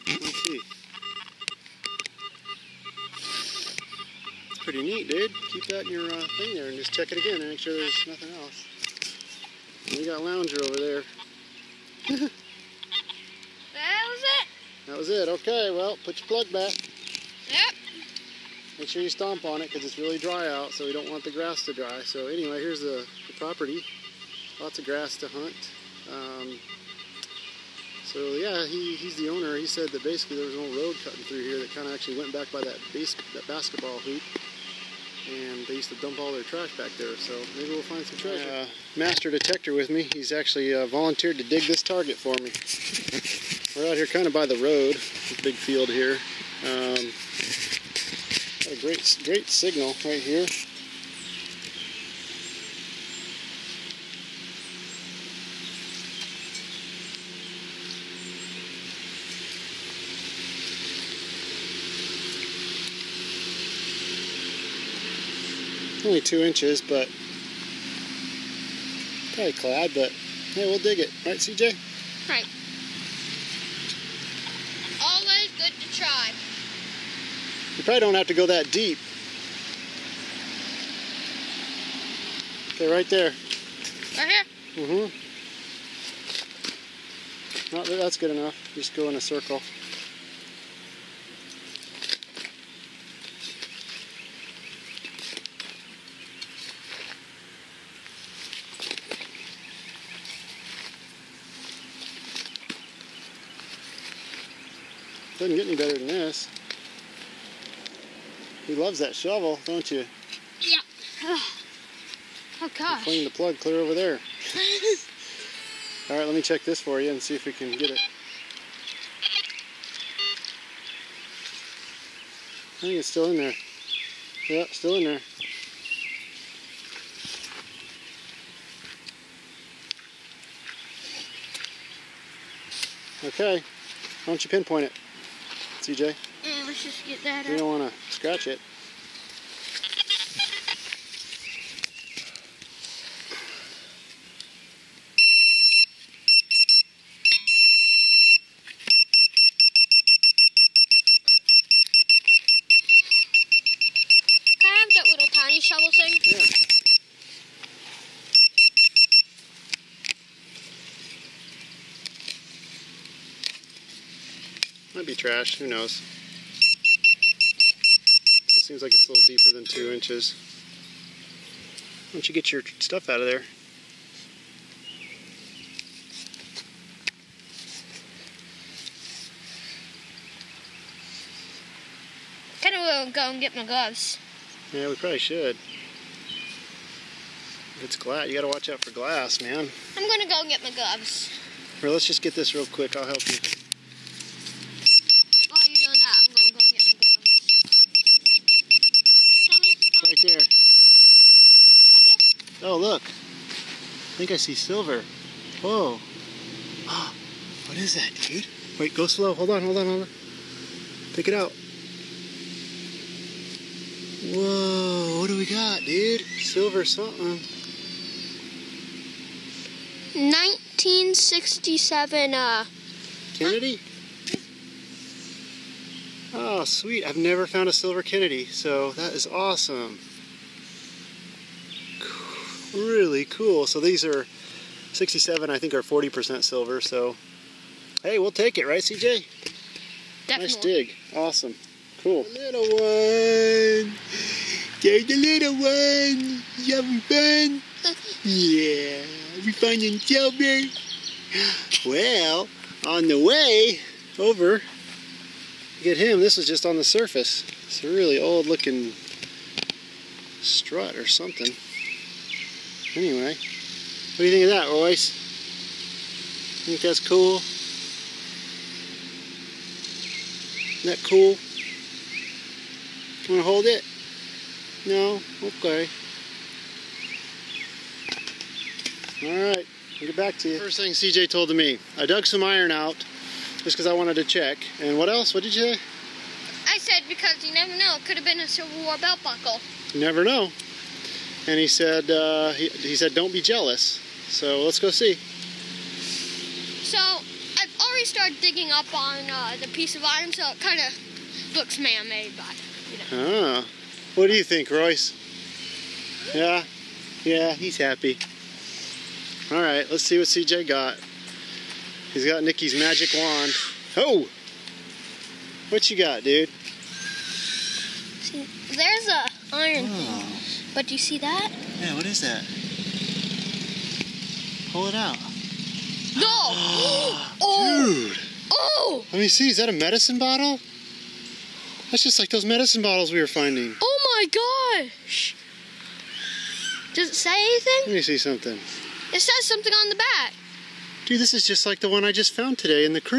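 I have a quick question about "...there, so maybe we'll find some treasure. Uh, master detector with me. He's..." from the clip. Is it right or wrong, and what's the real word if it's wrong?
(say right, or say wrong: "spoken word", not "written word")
right.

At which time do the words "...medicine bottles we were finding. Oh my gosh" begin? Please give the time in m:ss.
5:32.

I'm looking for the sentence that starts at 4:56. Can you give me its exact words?
So I've already started digging up on uh, the piece of iron, so it kind of looks man-made, but you know.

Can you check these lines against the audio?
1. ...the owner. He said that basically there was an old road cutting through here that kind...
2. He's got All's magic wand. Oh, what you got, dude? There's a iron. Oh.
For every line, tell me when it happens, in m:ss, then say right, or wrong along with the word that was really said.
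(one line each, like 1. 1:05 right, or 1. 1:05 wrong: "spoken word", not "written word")
1. 0:29 right
2. 5:12 wrong: "Nikki", not "All".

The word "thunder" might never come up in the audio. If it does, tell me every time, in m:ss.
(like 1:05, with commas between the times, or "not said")
not said.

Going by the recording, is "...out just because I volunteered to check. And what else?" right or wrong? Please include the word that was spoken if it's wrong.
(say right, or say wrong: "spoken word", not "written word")
wrong: "wanted", not "volunteered".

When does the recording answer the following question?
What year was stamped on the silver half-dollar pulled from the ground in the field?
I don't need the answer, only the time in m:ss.
3:40.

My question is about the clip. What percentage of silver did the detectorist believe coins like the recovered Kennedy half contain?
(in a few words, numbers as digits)
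40%.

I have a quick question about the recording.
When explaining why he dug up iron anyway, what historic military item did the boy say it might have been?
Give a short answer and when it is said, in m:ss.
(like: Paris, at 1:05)
Civil War belt buckle, at 4:48.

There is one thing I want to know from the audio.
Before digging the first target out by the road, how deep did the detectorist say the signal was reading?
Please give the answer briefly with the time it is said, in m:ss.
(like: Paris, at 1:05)
2 inches, at 1:06.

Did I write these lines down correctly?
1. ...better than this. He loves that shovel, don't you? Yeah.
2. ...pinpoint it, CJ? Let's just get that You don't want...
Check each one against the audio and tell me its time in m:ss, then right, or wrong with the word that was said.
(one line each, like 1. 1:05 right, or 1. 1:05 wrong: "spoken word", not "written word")
1. 1:45 right
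2. 2:14 right.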